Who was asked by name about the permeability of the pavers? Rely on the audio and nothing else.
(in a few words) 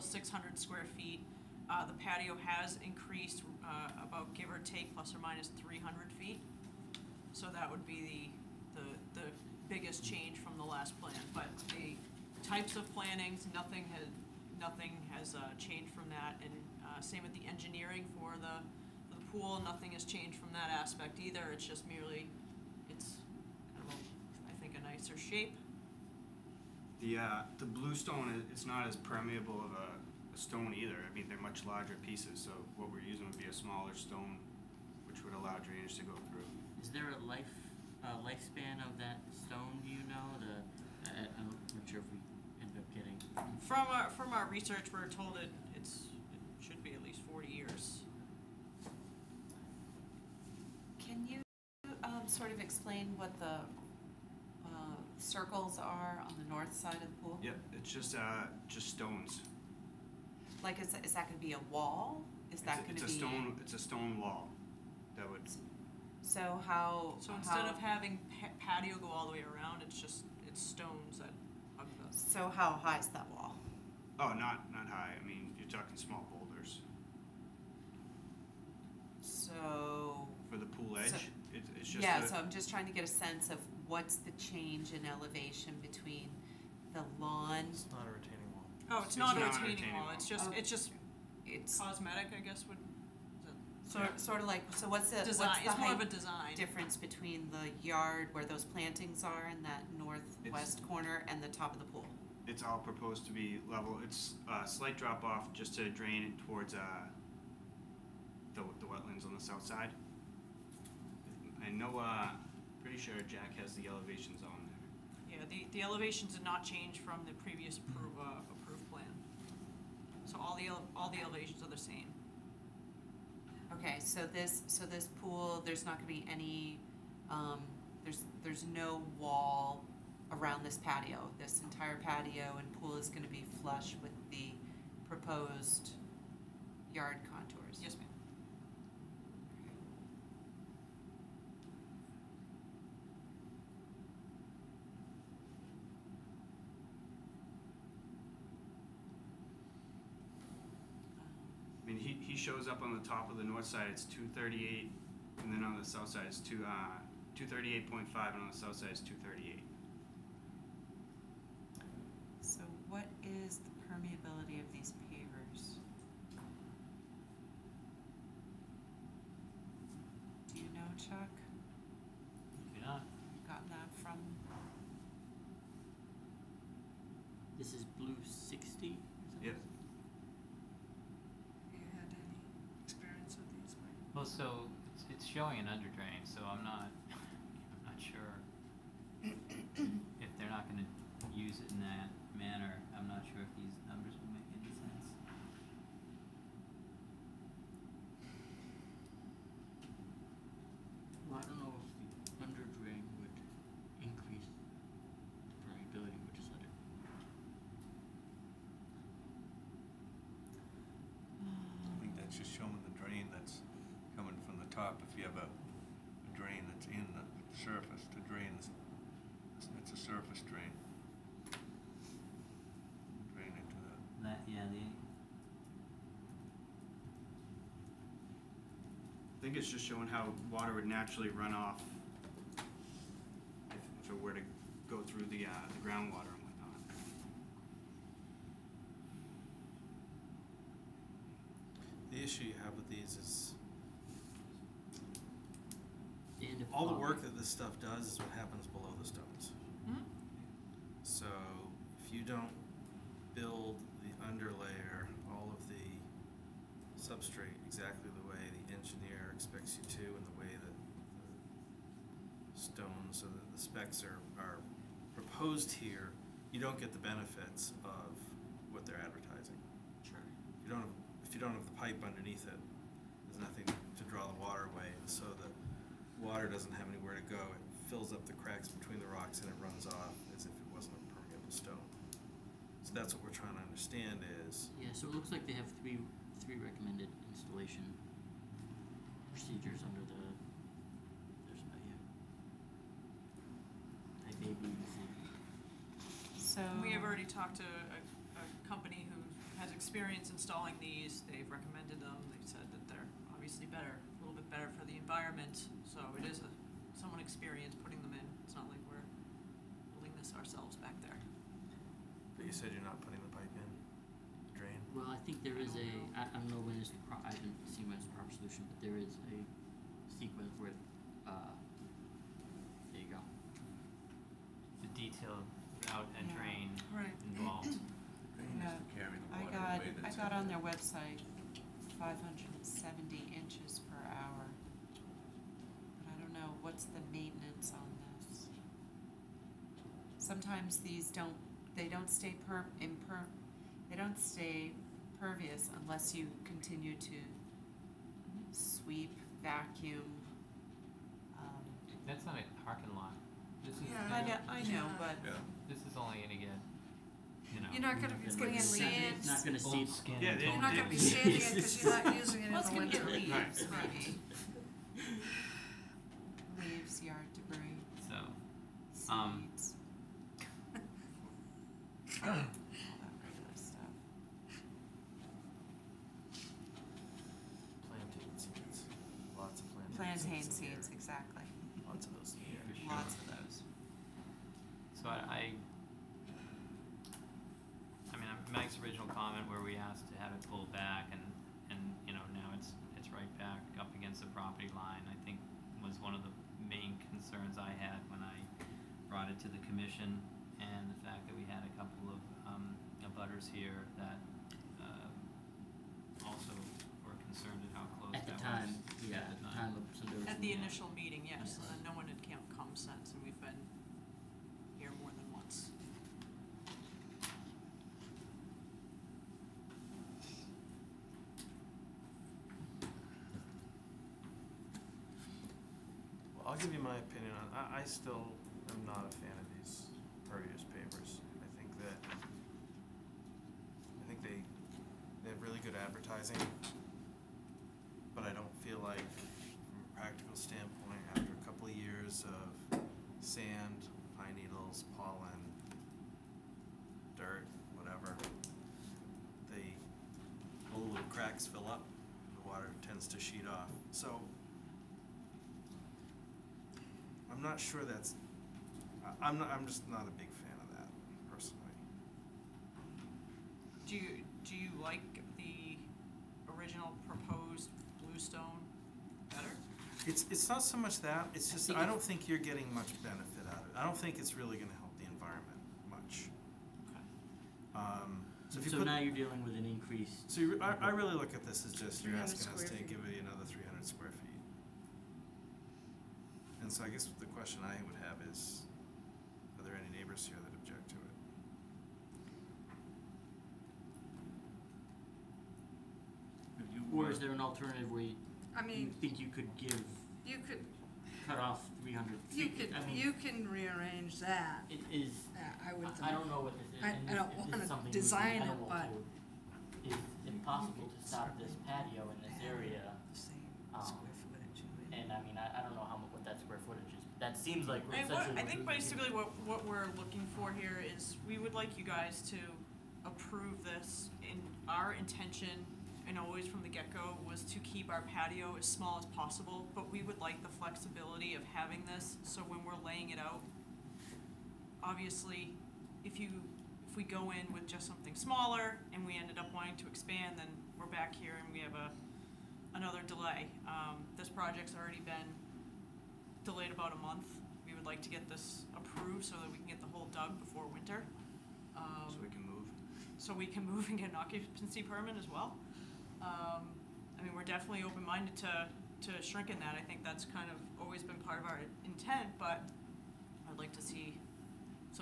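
Chuck.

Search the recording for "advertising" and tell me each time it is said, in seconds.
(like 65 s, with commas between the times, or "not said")
268 s, 435 s.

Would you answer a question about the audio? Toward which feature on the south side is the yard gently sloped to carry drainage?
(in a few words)
the wetlands.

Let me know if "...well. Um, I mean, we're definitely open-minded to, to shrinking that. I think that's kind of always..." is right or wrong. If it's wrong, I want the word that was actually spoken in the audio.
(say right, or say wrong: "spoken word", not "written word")
right.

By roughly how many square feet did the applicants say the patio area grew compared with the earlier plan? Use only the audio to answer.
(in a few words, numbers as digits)
300.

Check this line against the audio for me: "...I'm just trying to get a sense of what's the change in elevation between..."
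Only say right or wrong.
right.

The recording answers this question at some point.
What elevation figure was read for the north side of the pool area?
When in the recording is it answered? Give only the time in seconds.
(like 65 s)
157 s.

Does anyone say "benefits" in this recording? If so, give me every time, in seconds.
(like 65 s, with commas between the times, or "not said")
266 s, 473 s.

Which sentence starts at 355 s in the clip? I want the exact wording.
this is only gonna get, you know.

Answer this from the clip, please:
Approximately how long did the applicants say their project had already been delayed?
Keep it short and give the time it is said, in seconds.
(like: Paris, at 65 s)
about a month, at 546 s.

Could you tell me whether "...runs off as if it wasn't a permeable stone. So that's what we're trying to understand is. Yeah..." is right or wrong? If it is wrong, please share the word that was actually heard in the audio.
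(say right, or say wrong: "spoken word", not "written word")
right.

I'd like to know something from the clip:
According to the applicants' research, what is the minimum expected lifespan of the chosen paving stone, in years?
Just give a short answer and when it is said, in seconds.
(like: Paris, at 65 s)
40, at 47 s.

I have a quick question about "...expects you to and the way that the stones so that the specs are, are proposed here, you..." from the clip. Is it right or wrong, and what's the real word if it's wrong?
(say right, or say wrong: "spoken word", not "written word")
right.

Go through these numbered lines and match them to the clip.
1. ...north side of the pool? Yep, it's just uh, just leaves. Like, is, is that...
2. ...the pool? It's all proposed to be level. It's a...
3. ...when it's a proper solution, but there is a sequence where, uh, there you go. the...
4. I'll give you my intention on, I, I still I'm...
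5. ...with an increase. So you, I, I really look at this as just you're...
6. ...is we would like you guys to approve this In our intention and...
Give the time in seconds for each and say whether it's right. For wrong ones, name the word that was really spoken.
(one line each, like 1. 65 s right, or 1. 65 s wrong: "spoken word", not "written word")
1. 56 s wrong: "stones", not "leaves"
2. 101 s right
3. 317 s right
4. 426 s wrong: "opinion", not "intention"
5. 479 s right
6. 520 s right.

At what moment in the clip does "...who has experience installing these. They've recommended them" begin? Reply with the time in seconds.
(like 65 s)
299 s.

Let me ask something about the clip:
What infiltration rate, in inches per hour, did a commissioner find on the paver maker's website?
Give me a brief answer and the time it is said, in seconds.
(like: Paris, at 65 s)
570, at 331 s.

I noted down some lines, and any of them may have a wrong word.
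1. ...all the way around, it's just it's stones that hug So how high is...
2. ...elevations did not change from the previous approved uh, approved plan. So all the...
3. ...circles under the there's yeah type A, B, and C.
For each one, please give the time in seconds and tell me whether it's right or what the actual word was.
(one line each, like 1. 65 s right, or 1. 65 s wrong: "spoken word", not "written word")
1. 69 s right
2. 115 s right
3. 289 s wrong: "procedures", not "circles".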